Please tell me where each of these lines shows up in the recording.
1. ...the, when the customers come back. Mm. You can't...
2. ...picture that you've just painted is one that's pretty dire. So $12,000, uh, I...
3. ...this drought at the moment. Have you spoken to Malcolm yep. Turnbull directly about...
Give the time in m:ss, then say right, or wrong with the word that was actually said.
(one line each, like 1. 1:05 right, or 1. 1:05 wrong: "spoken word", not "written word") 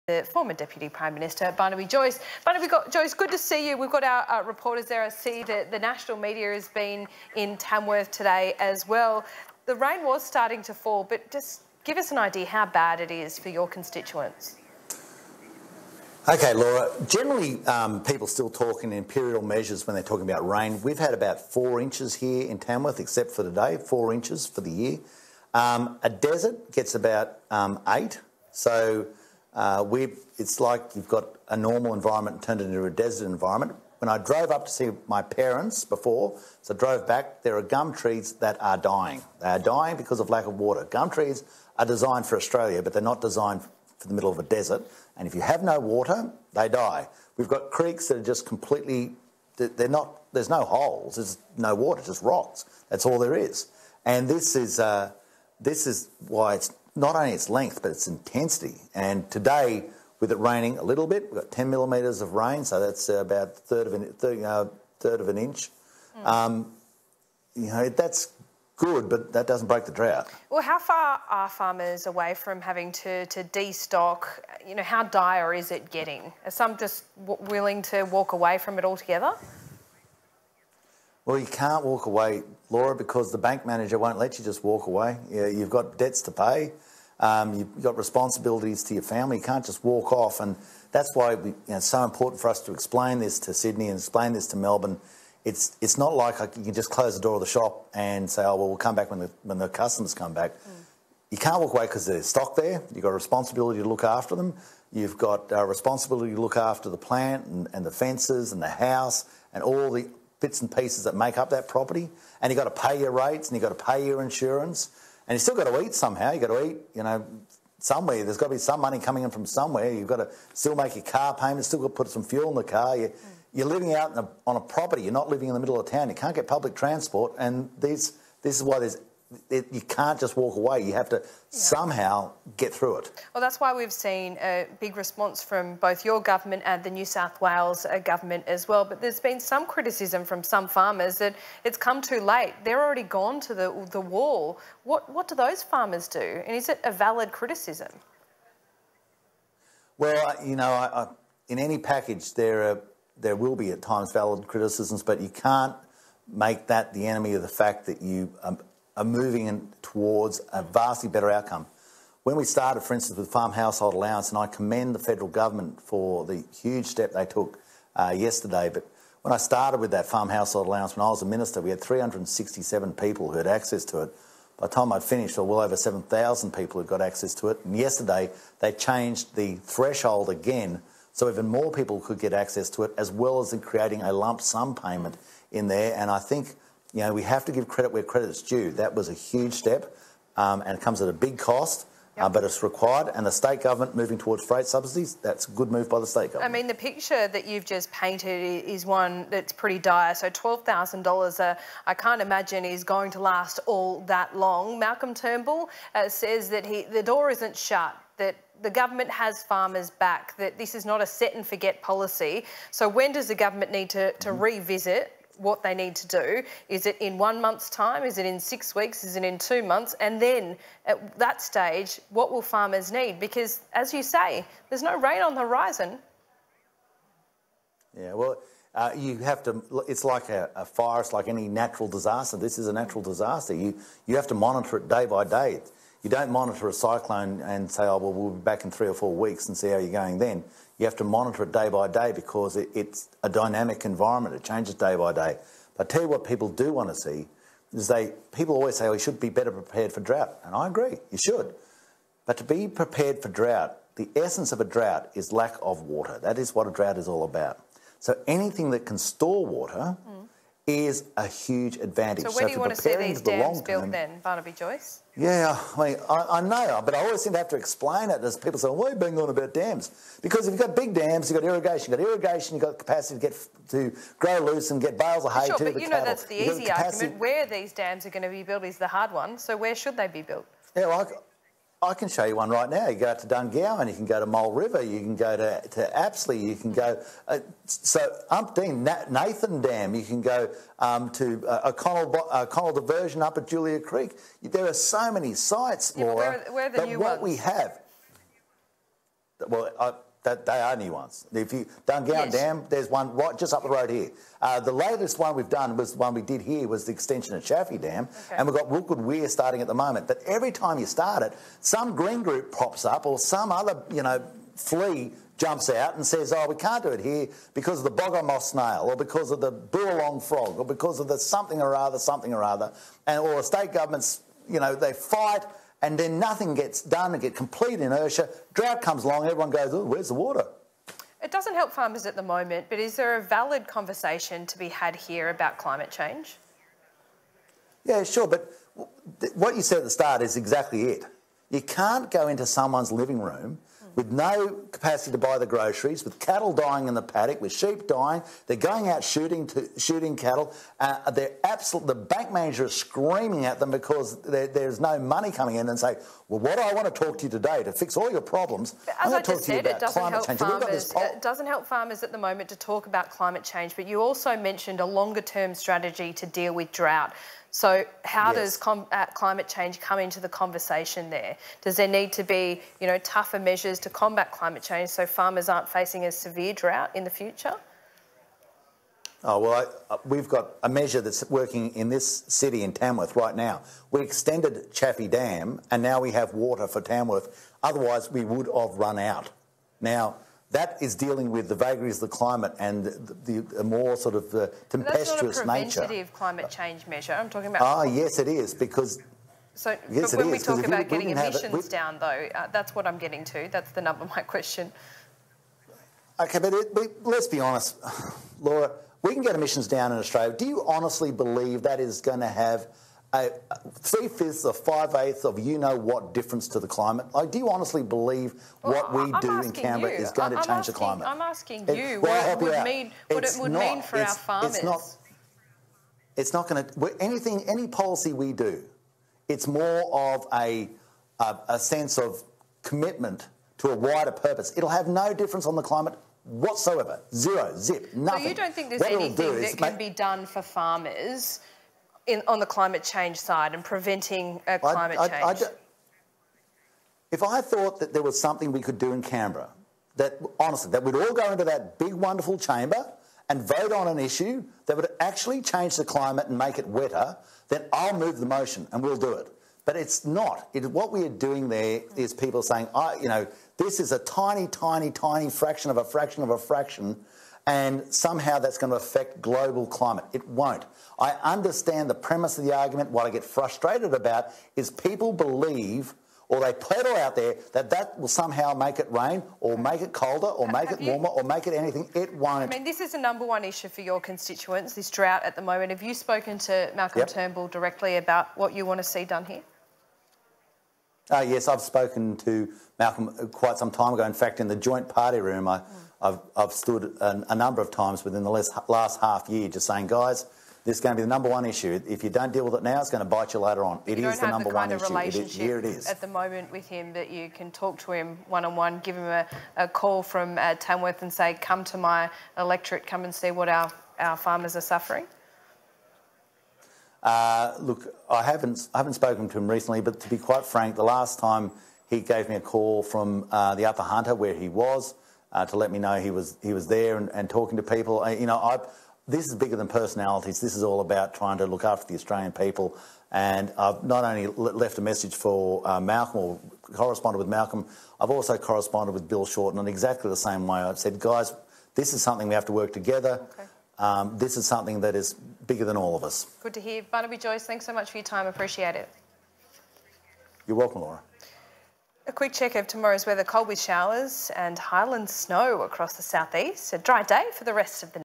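1. 1:39 right
2. 3:16 right
3. 8:04 right.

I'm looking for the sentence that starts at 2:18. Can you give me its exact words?
But there's been some criticism from some farmers that it's come too late.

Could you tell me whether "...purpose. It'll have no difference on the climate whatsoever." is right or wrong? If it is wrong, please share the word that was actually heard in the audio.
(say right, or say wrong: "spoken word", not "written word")
right.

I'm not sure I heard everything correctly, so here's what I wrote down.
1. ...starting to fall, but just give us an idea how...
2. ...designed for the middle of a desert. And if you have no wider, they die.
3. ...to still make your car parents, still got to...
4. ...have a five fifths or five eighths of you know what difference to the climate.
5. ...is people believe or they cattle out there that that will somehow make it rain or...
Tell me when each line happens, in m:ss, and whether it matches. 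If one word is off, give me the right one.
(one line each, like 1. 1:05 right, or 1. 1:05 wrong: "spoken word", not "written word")
1. 0:10 right
2. 0:43 wrong: "water", not "wider"
3. 2:00 wrong: "payments", not "parents"
4. 6:52 wrong: "three", not "five"
5. 7:54 wrong: "peddle", not "cattle".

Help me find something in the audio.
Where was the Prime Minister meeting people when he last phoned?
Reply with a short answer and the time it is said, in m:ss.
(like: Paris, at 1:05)
Upper Hunter, at 8:43.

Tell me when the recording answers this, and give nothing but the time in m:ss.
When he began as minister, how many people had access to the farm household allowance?
2:51.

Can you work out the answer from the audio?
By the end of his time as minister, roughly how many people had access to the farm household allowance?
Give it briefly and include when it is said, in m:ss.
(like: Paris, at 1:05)
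over 7,000, at 2:55.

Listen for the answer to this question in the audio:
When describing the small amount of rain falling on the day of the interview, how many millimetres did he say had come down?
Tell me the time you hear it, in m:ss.
1:01.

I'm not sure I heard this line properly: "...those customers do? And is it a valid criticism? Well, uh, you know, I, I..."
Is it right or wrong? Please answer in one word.
wrong.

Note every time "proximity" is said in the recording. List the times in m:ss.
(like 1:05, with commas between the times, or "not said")
not said.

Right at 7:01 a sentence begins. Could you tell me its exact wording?
I'm asking you it, what it would, mean, what it would not, mean for our farmers.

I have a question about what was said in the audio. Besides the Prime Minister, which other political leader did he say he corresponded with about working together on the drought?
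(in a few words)
Bill Shorten.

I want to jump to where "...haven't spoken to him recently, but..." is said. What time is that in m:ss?
8:38.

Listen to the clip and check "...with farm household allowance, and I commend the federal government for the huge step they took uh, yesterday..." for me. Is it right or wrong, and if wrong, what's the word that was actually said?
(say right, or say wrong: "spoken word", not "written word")
right.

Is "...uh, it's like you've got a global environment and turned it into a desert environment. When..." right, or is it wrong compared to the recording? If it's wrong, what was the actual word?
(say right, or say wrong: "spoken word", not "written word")
wrong: "normal", not "global".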